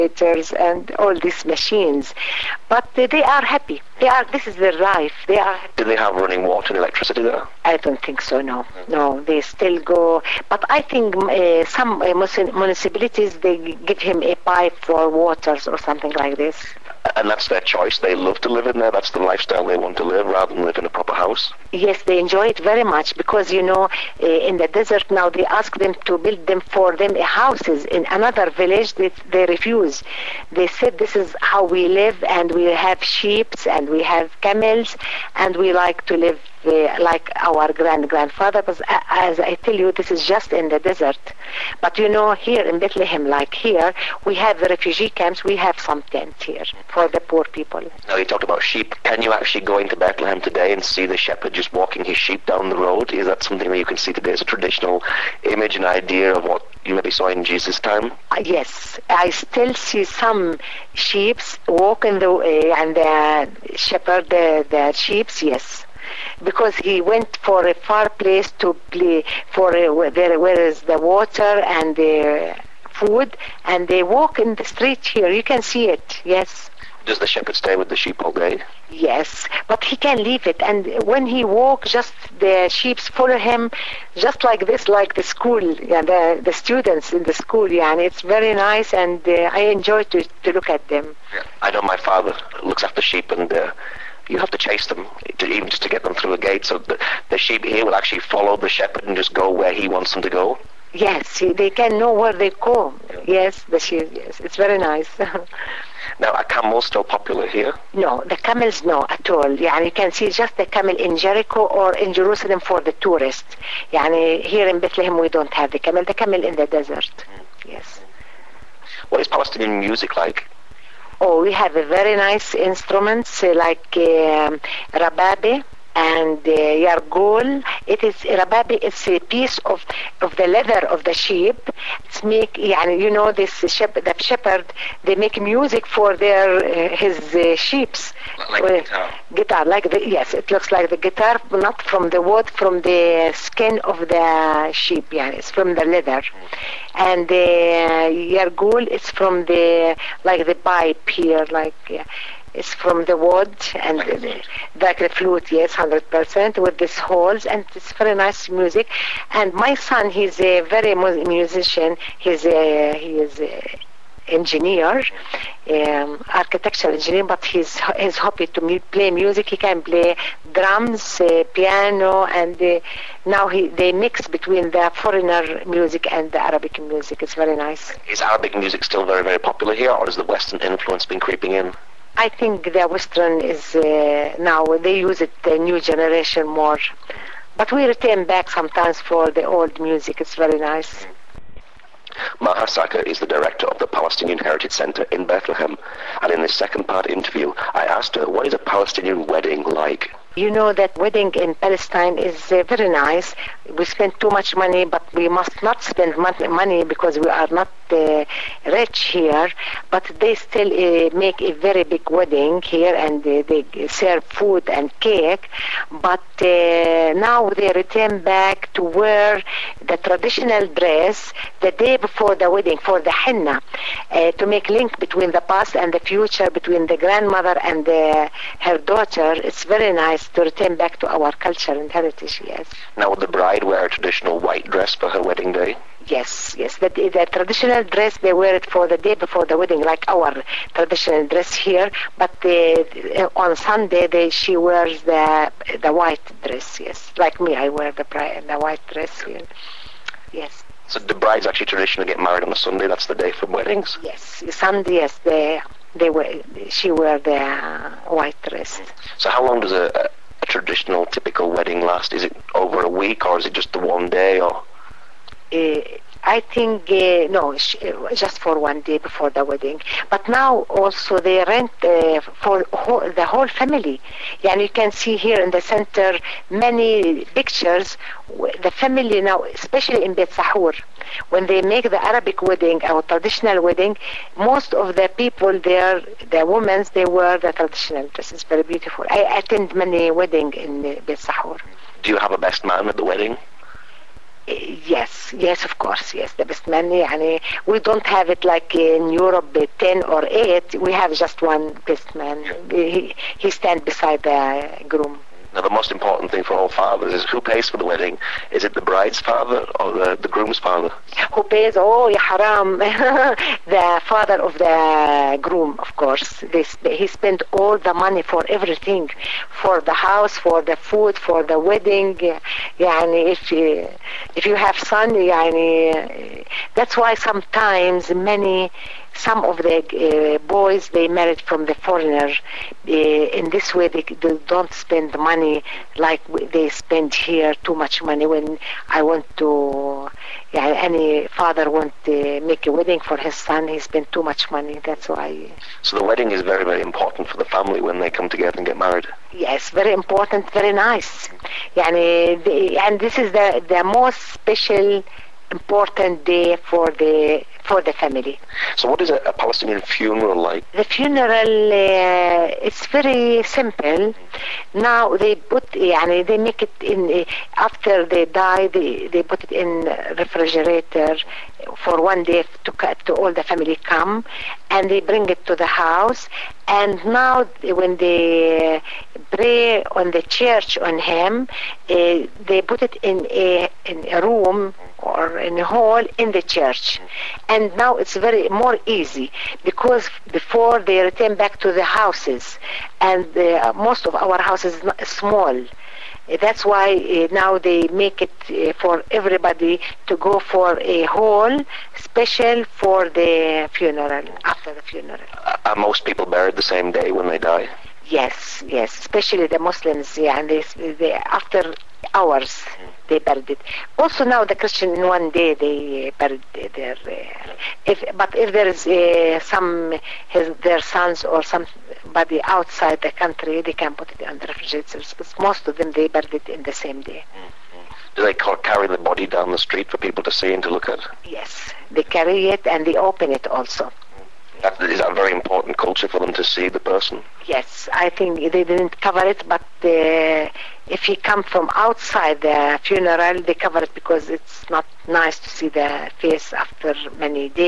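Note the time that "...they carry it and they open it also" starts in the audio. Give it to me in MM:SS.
07:11.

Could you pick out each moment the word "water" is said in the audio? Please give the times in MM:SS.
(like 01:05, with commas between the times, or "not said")
00:06, 00:15, 01:10.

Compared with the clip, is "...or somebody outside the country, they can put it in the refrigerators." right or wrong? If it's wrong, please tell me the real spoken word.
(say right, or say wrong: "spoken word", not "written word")
right.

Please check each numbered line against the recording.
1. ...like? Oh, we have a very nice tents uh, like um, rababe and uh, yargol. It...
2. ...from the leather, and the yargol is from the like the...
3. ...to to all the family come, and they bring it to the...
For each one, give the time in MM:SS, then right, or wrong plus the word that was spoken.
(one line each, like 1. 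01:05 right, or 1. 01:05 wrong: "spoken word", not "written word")
1. 02:00 wrong: "instruments", not "tents"
2. 02:25 right
3. 06:12 right.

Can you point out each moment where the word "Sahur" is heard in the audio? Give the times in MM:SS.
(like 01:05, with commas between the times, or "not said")
04:40, 04:51.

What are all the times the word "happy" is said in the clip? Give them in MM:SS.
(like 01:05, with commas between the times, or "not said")
00:03, 02:48.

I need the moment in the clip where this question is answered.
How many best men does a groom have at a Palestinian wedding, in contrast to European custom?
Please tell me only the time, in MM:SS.
05:01.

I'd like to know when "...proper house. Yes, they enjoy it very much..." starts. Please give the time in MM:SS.
00:20.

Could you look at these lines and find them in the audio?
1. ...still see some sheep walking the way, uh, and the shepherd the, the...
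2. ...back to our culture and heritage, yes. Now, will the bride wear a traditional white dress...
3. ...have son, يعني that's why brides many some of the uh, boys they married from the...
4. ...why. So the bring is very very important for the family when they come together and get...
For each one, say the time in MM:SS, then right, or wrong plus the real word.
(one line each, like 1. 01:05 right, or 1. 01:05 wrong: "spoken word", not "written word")
1. 00:59 right
2. 03:50 right
3. 05:24 wrong: "sometimes", not "brides"
4. 05:45 wrong: "wedding", not "bring".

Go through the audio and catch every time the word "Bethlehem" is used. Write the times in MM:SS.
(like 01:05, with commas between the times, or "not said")
00:42, 00:49, 01:54, 03:15.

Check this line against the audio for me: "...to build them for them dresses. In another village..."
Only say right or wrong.
wrong.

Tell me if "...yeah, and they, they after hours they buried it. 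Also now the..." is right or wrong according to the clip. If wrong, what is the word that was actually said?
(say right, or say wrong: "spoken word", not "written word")
right.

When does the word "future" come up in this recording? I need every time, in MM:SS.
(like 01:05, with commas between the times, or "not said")
03:45.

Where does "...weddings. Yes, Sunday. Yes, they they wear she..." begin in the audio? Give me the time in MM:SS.
04:13.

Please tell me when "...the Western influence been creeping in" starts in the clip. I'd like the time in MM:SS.
03:00.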